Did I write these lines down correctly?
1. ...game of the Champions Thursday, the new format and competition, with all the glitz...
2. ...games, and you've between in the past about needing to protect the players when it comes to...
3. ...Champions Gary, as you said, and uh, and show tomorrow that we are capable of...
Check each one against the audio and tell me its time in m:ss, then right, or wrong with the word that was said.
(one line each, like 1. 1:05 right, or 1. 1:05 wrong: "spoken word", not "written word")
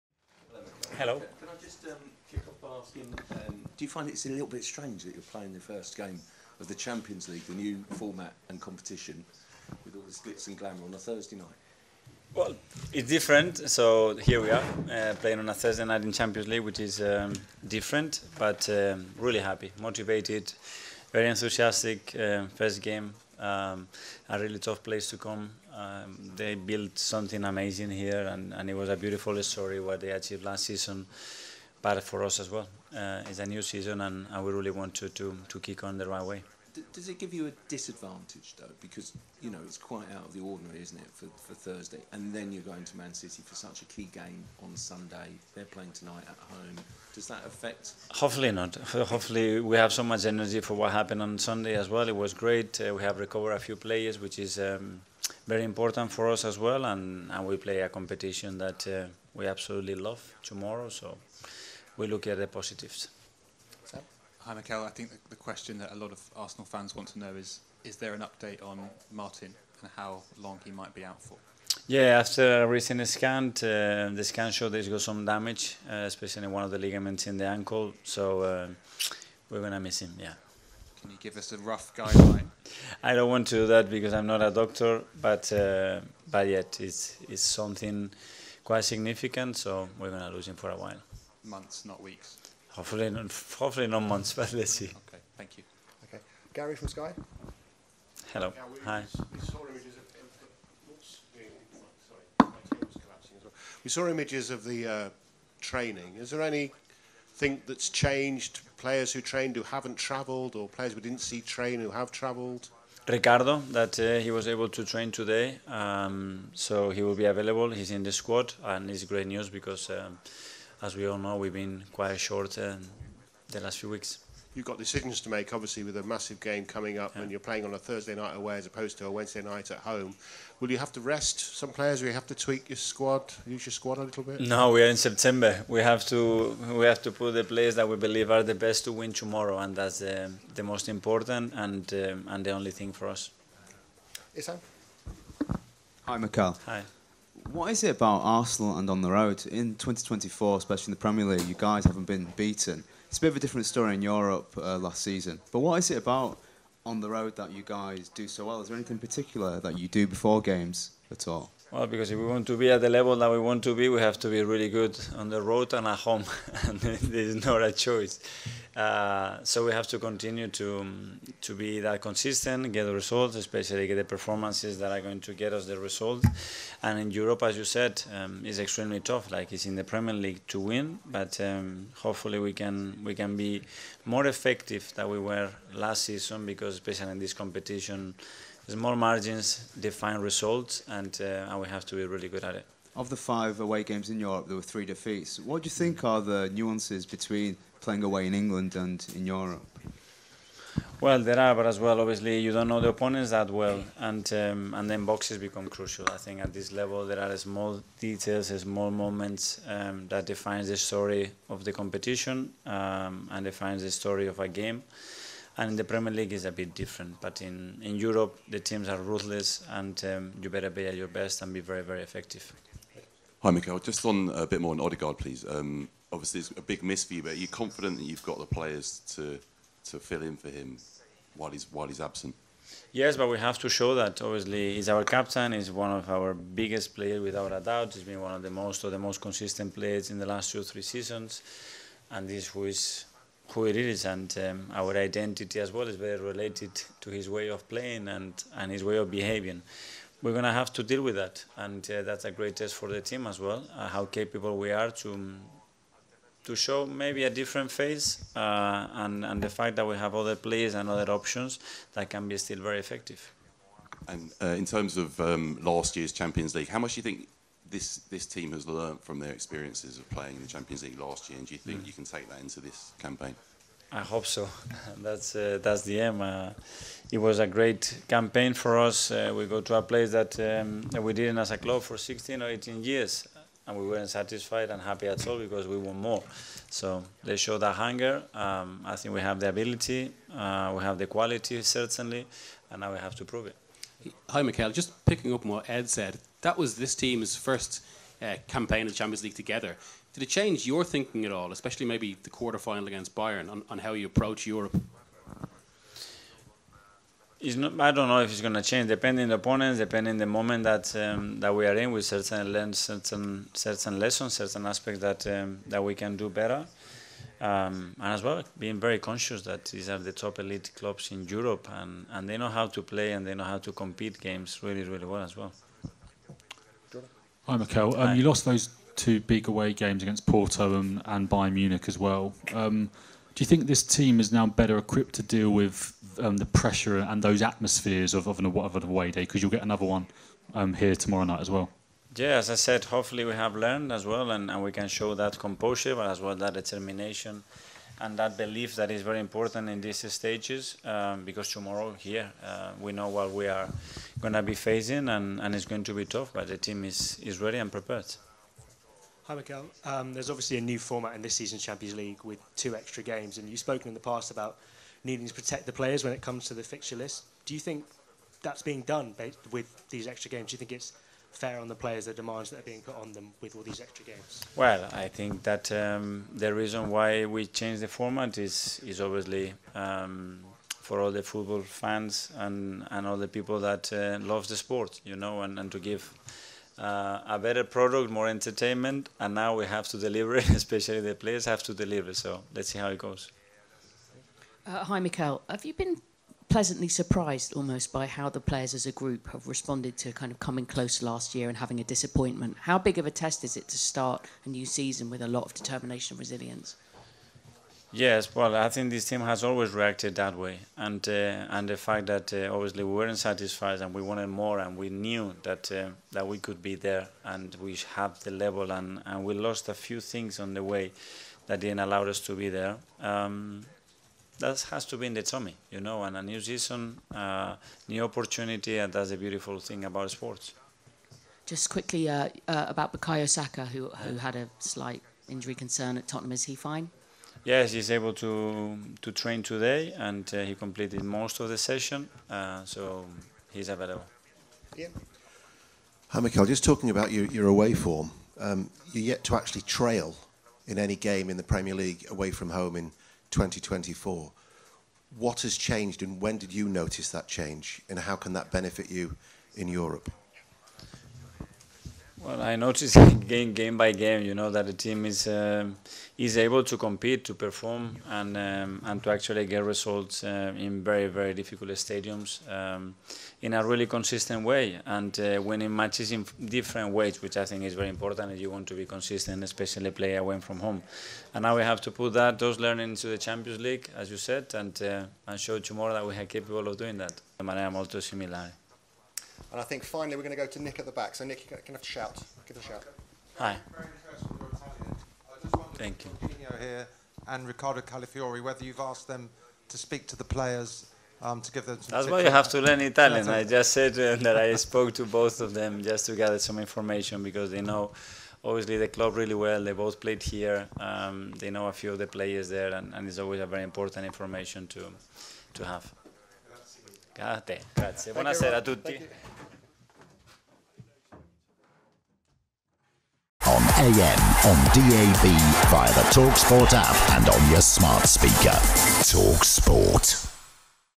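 1. 0:05 wrong: "League", not "Thursday"
2. 6:03 wrong: "spoken", not "between"
3. 8:03 wrong: "League", not "Gary".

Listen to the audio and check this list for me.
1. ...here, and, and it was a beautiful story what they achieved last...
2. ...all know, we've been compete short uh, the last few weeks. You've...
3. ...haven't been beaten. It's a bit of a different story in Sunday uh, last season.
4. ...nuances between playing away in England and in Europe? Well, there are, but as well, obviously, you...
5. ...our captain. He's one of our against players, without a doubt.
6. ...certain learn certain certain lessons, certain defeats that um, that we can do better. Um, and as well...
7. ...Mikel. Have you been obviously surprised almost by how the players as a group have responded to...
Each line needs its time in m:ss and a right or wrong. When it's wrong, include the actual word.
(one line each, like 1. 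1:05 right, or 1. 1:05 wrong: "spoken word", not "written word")
1. 0:27 right
2. 2:01 wrong: "quite", not "compete"
3. 2:31 wrong: "Europe", not "Sunday"
4. 3:16 right
5. 3:54 wrong: "biggest", not "against"
6. 5:12 wrong: "aspects", not "defeats"
7. 6:34 wrong: "pleasantly", not "obviously".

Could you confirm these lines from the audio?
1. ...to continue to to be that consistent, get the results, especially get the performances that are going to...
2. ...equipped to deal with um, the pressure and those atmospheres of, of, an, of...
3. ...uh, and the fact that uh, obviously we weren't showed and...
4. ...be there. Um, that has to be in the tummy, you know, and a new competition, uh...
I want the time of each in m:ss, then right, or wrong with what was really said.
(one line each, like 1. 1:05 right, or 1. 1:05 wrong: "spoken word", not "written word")
1. 2:49 right
2. 5:34 right
3. 6:51 wrong: "satisfied", not "showed"
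4. 7:02 wrong: "season", not "competition".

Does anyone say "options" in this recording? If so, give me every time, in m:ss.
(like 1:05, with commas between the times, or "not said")
4:21.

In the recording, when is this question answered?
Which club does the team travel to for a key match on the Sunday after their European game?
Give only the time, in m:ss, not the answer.
0:42.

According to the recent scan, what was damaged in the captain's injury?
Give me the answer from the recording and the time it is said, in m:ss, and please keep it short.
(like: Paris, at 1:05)
Ligaments in the ankle, at 1:16.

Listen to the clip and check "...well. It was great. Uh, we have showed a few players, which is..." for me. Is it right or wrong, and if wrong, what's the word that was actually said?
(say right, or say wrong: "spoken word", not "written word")
wrong: "recovered", not "showed".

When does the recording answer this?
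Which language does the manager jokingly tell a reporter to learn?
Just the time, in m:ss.
8:22.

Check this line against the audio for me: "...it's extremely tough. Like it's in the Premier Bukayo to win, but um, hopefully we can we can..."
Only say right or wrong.
wrong.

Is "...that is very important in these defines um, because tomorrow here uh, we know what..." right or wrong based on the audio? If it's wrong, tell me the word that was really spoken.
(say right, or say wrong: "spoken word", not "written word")
wrong: "stages", not "defines".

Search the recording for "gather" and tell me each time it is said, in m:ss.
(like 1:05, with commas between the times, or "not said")
8:26.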